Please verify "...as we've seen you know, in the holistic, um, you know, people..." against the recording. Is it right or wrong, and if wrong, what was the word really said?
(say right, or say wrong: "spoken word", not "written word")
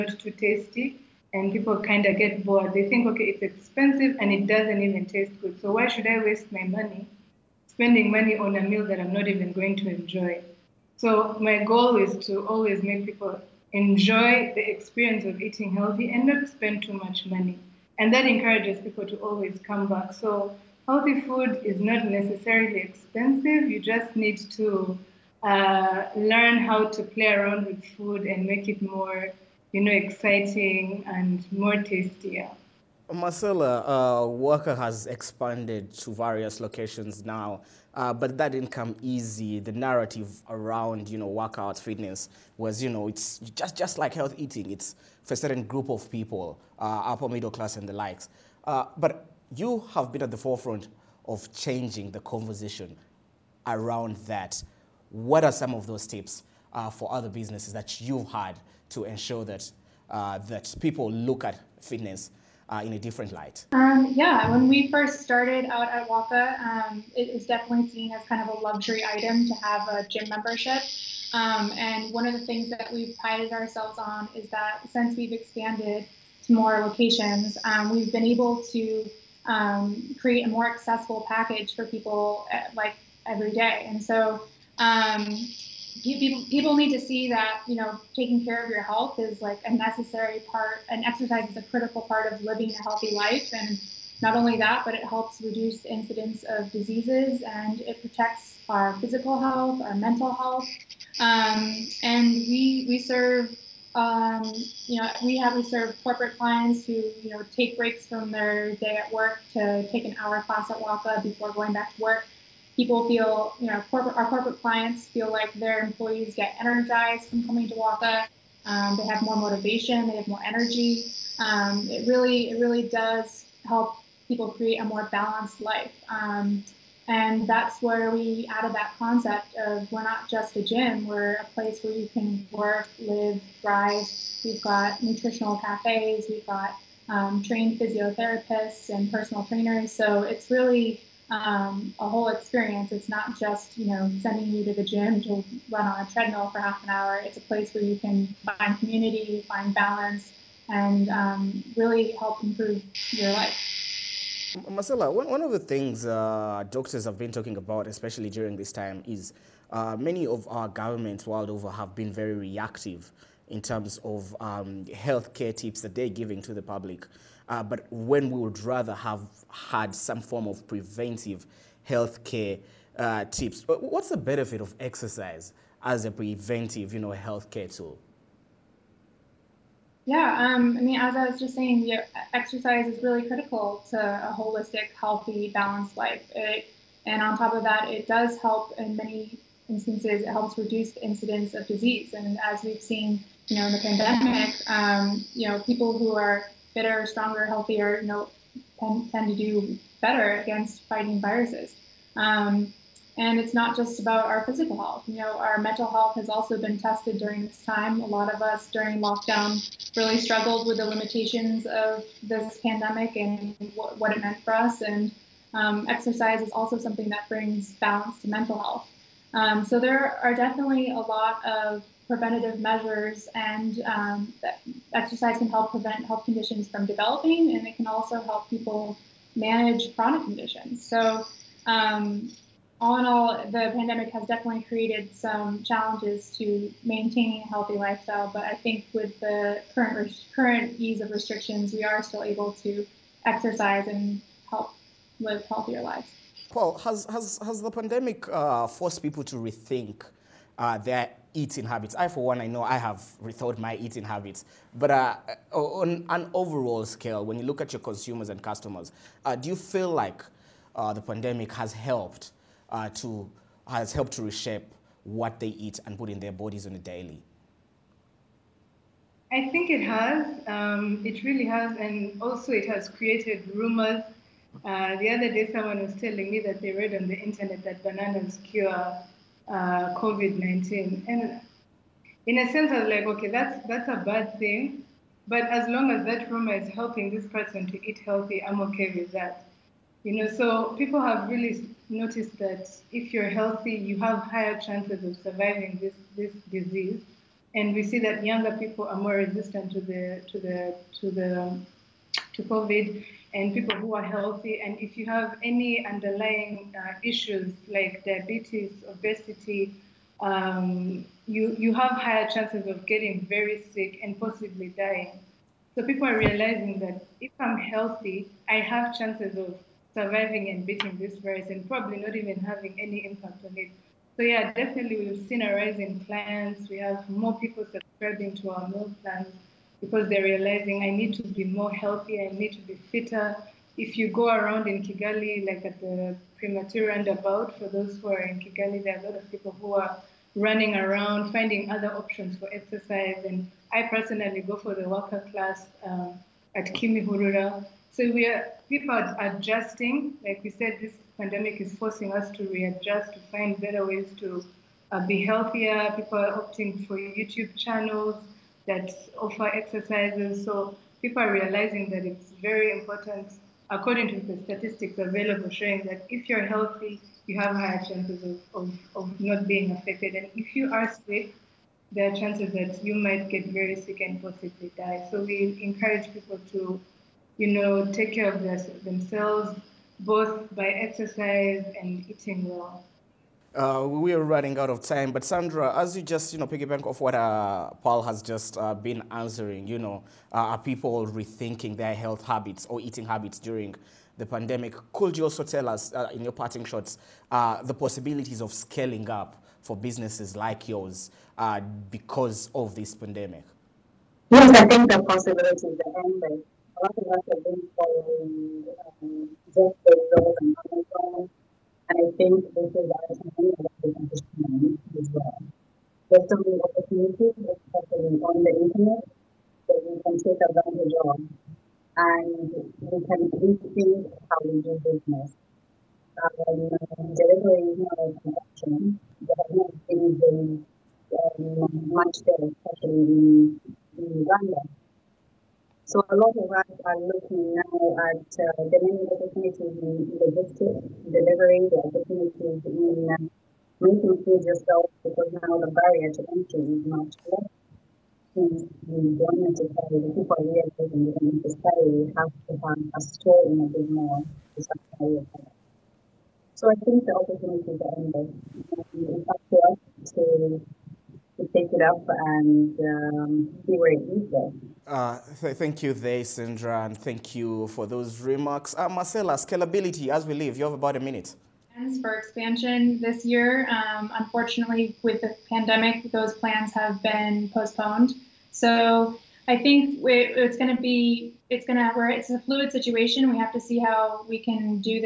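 wrong: "pandemic", not "holistic".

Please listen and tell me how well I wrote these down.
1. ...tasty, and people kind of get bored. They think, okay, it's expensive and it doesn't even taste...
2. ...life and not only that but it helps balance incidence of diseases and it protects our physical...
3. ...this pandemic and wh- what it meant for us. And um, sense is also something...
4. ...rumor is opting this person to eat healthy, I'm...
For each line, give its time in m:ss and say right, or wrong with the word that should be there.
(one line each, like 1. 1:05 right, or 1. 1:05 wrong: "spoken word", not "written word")
1. 0:00 right
2. 1:33 wrong: "reduce", not "balance"
3. 3:32 wrong: "exercise", not "sense"
4. 4:46 wrong: "helping", not "opting".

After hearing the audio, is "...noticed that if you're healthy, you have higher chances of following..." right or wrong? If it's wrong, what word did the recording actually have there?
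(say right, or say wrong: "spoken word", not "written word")
wrong: "surviving", not "following".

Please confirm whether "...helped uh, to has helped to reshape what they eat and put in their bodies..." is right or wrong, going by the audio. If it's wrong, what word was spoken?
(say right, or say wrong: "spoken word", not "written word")
right.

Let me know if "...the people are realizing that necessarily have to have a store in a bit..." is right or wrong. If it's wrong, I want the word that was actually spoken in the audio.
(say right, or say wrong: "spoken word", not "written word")
right.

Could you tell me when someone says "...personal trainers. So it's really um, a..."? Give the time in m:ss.
2:19.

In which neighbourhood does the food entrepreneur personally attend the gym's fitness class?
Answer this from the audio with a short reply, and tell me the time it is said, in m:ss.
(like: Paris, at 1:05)
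Kimihurura, at 5:46.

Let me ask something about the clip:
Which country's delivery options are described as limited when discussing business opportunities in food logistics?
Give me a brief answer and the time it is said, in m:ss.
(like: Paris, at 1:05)
Uganda, at 7:14.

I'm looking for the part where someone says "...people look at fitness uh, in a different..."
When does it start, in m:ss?
1:00.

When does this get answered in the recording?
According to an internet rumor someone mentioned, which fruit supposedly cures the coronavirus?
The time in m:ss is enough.
4:37.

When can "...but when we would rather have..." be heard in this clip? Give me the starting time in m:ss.
2:47.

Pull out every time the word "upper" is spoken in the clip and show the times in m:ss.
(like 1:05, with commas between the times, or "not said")
0:47.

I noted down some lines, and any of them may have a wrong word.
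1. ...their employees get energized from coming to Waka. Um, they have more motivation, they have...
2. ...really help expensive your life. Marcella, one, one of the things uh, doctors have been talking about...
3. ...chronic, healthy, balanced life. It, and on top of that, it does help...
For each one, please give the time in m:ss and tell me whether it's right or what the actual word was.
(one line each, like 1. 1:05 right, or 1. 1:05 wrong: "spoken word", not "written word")
1. 1:55 right
2. 2:31 wrong: "improve", not "expensive"
3. 3:04 wrong: "holistic", not "chronic".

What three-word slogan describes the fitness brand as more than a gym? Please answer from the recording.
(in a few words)
work, live, thrive.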